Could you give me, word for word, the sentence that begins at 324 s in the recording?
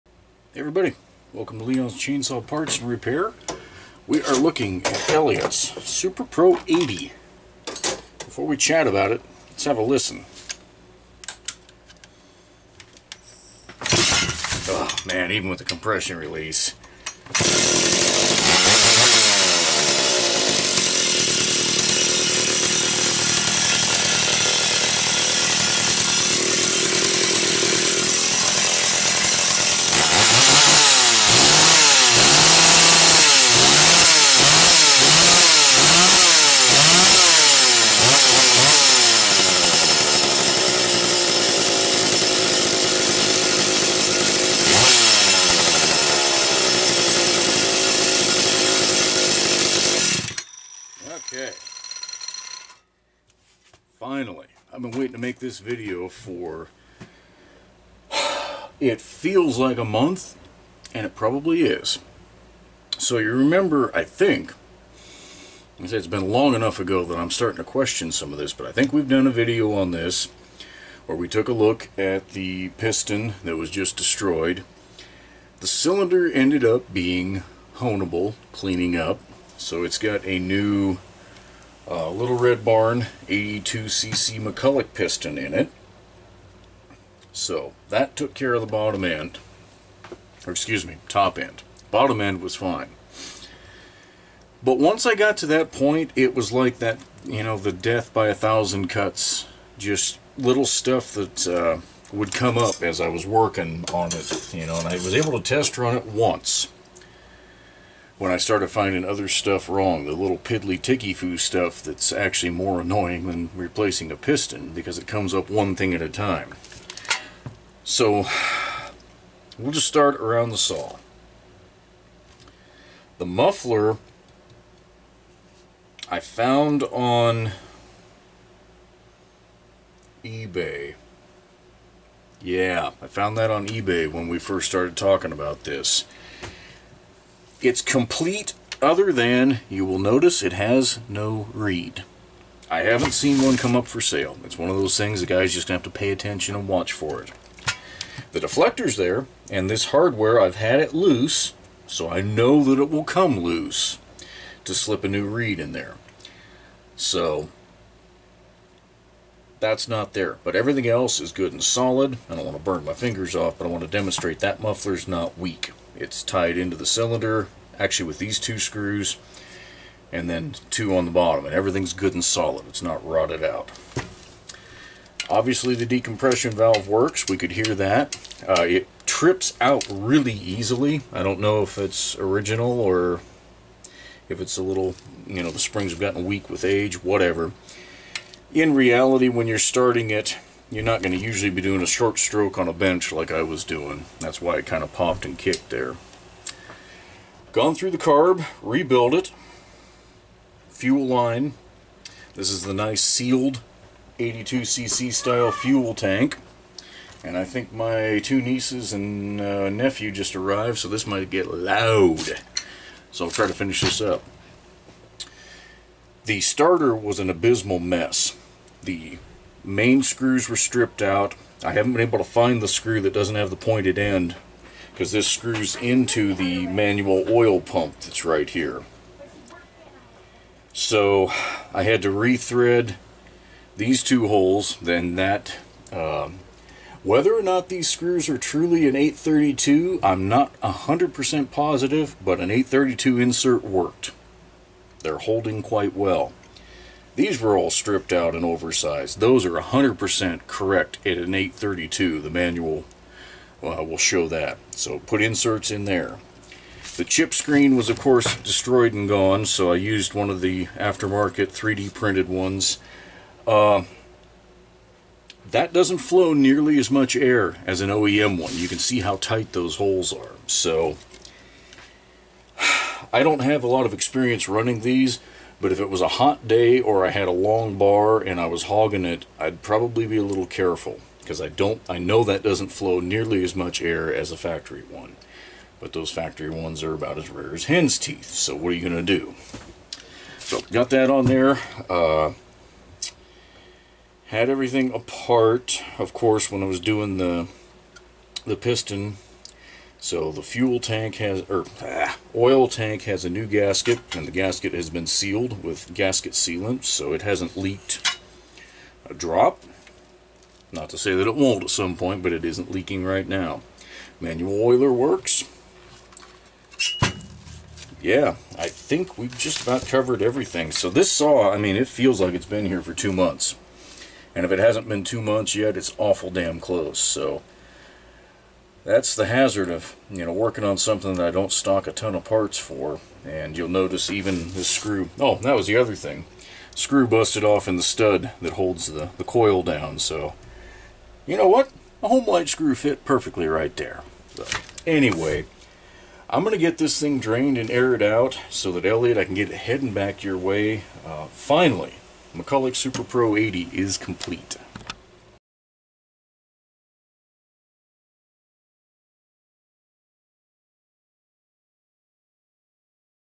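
And if it hasn't been two months yet, it's awful damn close.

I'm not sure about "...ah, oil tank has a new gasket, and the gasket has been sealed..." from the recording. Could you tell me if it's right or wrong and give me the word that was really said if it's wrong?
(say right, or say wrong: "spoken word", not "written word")
right.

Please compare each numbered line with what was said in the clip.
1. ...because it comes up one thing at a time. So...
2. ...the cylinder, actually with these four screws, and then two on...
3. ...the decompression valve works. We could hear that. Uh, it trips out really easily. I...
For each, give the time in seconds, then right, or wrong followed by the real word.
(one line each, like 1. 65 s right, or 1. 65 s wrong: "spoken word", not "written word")
1. 114 s right
2. 166 s wrong: "two", not "four"
3. 175 s right.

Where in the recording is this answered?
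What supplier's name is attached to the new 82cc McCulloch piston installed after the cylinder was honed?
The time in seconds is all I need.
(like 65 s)
82 s.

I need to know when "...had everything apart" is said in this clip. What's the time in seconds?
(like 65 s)
294 s.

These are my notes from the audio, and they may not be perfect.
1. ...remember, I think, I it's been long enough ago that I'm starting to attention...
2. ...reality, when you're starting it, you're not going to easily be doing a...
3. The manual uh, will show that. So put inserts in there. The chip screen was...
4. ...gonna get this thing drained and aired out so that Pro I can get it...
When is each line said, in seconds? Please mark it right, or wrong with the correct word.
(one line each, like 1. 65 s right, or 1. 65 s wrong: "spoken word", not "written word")
1. 63 s wrong: "question", not "attention"
2. 188 s wrong: "usually", not "easily"
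3. 252 s right
4. 346 s wrong: "Elliott", not "Pro".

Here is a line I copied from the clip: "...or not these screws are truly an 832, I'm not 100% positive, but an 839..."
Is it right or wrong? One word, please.
wrong.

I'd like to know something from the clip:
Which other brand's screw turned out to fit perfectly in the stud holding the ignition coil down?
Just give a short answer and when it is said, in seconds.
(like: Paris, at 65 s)
Homelite, at 342 s.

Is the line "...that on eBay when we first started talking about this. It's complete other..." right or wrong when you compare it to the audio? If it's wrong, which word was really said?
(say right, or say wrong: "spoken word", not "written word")
right.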